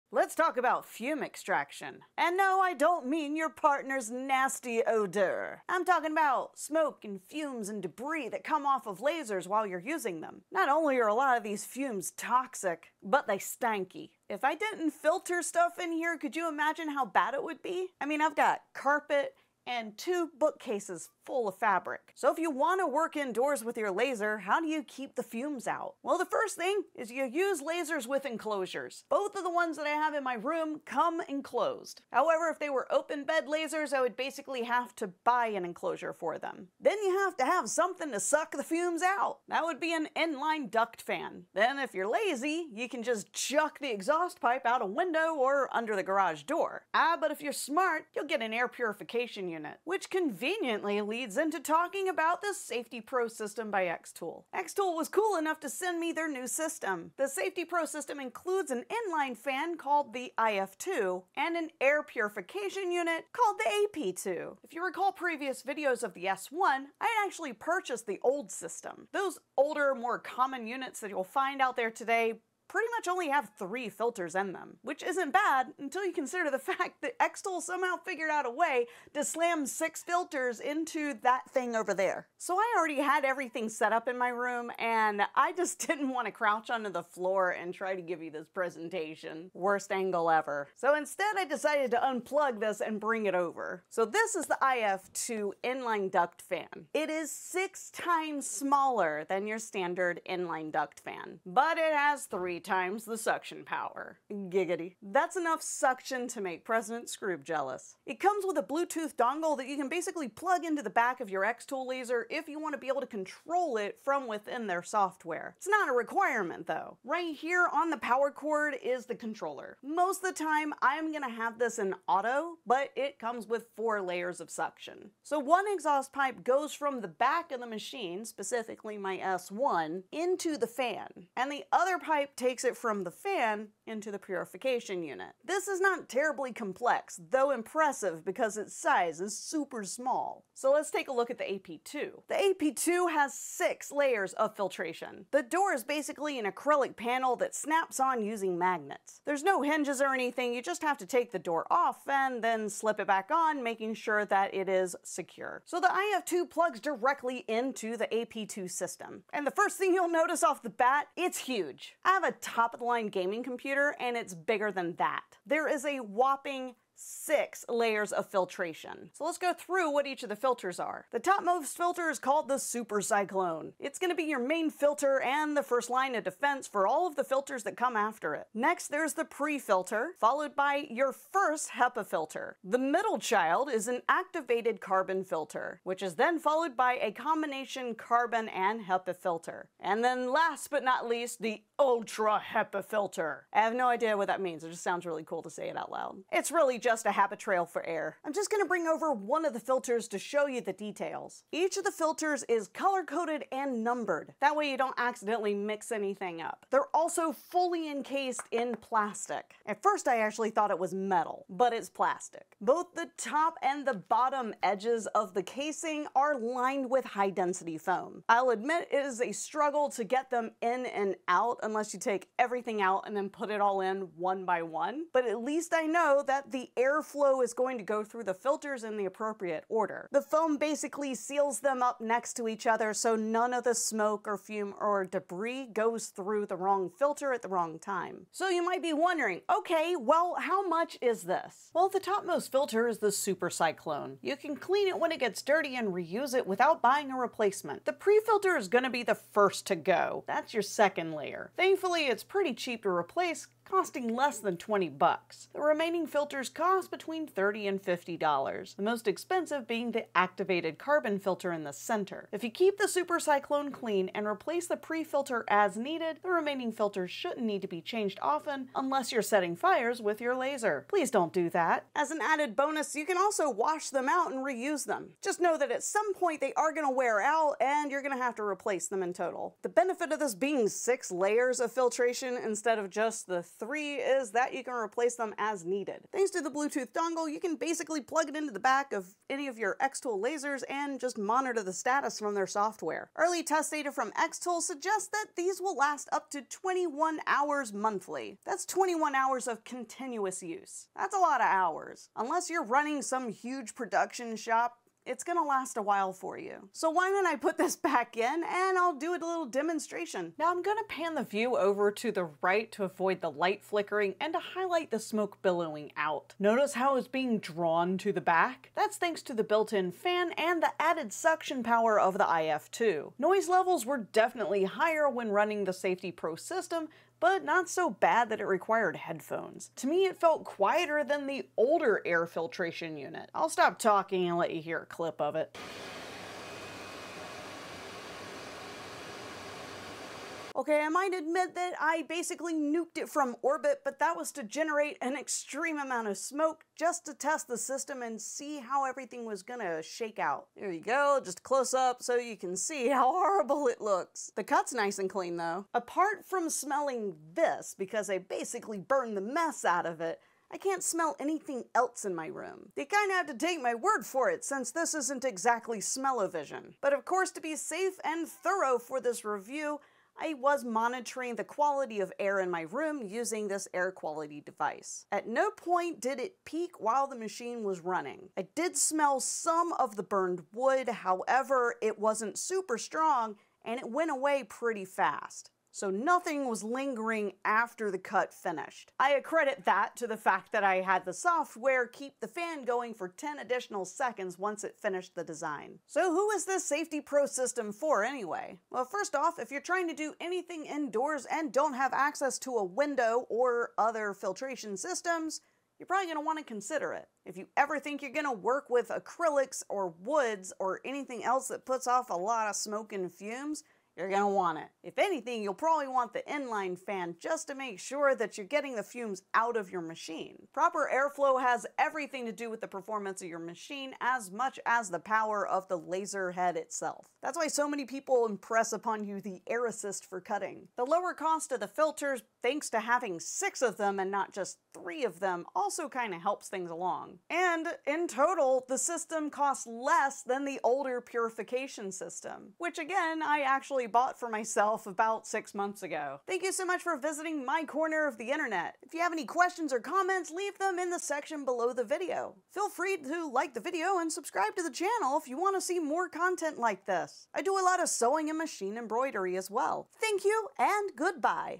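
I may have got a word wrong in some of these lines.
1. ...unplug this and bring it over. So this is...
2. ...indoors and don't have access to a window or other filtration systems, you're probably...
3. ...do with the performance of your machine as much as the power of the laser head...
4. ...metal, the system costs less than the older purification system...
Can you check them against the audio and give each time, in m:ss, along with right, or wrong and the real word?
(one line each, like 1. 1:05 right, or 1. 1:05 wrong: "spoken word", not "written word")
1. 1:31 right
2. 6:40 right
3. 7:02 right
4. 7:18 wrong: "total", not "metal".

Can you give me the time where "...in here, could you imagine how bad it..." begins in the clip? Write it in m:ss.
0:15.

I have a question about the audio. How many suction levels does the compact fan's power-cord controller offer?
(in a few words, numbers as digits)
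4.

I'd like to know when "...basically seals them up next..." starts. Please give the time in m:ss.
3:50.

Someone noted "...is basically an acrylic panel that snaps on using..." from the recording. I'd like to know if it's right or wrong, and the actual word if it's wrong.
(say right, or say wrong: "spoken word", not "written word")
right.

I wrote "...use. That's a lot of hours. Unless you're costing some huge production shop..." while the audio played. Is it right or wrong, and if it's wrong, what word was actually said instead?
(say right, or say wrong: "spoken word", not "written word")
wrong: "running", not "costing".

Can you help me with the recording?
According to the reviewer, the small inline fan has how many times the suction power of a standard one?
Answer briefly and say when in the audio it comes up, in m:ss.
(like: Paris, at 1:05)
3, at 1:42.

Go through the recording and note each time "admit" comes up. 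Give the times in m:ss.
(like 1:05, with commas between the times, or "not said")
3:38, 5:41.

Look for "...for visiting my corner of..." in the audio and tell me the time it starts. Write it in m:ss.
7:26.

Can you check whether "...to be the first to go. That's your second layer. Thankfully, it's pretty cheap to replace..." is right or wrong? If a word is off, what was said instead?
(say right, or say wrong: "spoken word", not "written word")
right.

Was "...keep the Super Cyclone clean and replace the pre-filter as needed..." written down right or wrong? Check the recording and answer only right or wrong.
right.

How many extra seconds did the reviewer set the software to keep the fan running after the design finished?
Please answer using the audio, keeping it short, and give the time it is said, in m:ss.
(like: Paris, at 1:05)
10, at 6:33.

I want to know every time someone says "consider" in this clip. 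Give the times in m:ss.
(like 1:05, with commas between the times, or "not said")
1:16, 6:46.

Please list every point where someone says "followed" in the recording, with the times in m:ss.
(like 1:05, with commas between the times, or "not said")
3:00, 3:06.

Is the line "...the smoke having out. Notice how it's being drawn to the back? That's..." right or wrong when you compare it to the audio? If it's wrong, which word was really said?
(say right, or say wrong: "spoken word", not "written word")
wrong: "billowing", not "having".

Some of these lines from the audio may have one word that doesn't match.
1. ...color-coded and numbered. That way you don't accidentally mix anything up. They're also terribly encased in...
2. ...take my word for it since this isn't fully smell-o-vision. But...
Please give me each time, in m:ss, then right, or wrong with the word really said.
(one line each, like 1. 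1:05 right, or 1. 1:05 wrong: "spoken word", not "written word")
1. 3:22 wrong: "fully", not "terribly"
2. 6:03 wrong: "exactly", not "fully".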